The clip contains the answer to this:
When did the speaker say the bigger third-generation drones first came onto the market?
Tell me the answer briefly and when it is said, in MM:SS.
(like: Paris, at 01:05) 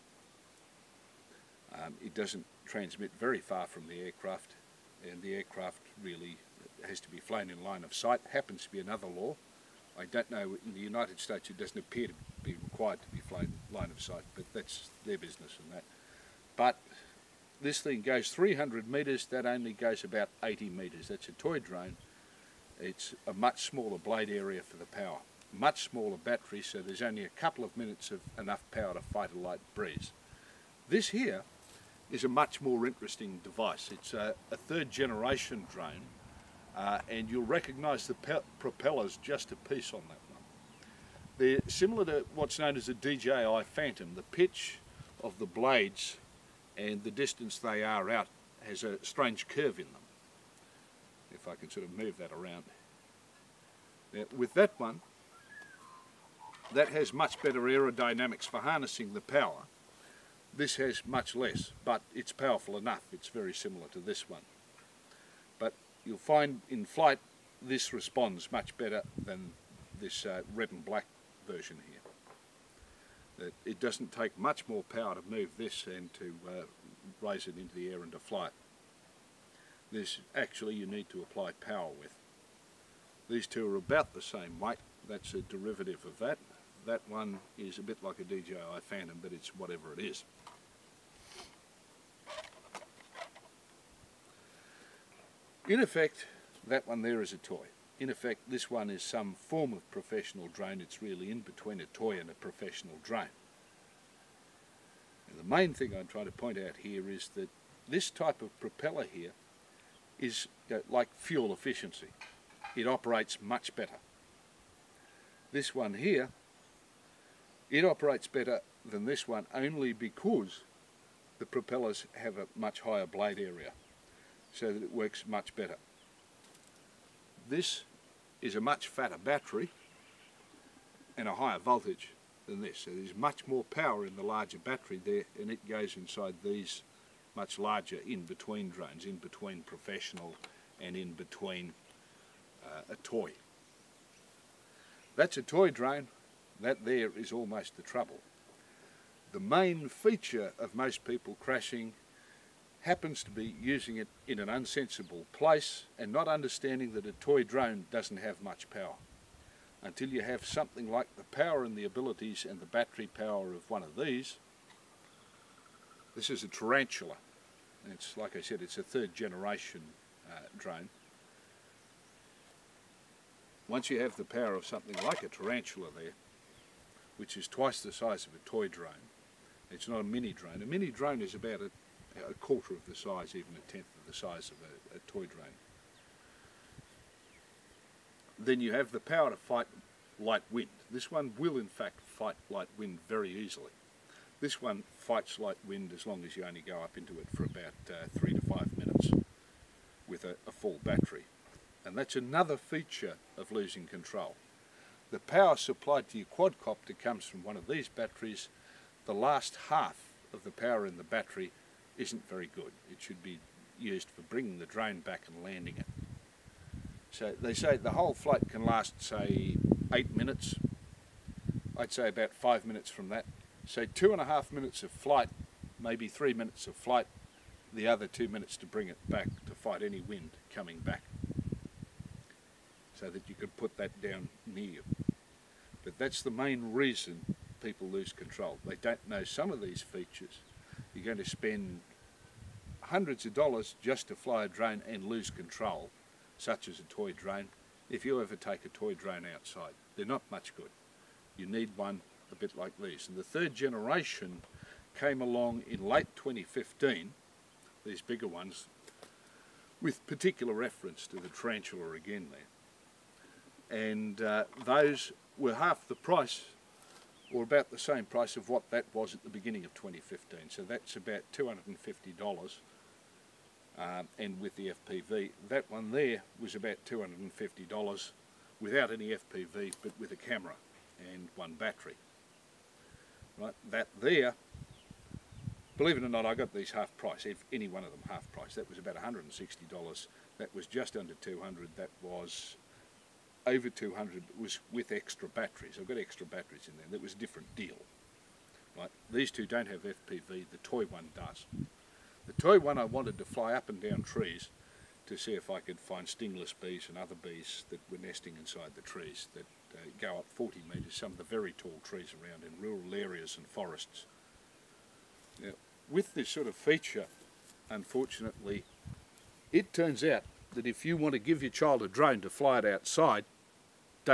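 late 2015, at 04:15.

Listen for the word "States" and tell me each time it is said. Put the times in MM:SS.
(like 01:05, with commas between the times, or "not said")
00:11.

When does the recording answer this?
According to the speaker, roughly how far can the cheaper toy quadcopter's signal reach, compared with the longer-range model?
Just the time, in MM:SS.
00:20.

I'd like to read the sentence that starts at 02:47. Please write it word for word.
it's like I said, it's a third generation uh, drone.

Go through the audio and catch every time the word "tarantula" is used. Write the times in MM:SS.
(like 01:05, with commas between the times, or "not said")
02:46, 02:55, 04:21.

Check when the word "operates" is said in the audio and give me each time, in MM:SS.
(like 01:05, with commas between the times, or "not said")
01:52, 01:57.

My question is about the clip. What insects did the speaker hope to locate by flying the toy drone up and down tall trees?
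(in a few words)
stingless bees.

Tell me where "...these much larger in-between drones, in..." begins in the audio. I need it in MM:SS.
02:16.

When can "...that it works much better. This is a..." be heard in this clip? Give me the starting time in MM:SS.
02:04.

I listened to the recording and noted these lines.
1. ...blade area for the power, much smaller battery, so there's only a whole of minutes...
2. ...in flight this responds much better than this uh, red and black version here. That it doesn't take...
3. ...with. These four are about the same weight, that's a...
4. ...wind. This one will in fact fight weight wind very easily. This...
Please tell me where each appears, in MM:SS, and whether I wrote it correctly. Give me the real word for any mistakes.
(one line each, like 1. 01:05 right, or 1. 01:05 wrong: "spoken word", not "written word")
1. 00:23 wrong: "couple", not "whole"
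2. 01:06 right
3. 01:21 wrong: "two", not "four"
4. 03:10 wrong: "light", not "weight".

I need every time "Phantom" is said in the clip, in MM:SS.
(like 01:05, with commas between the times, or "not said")
00:43, 01:28.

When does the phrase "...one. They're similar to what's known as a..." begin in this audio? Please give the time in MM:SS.
00:40.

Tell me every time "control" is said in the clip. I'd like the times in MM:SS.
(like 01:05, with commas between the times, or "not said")
03:23, 03:58, 04:05.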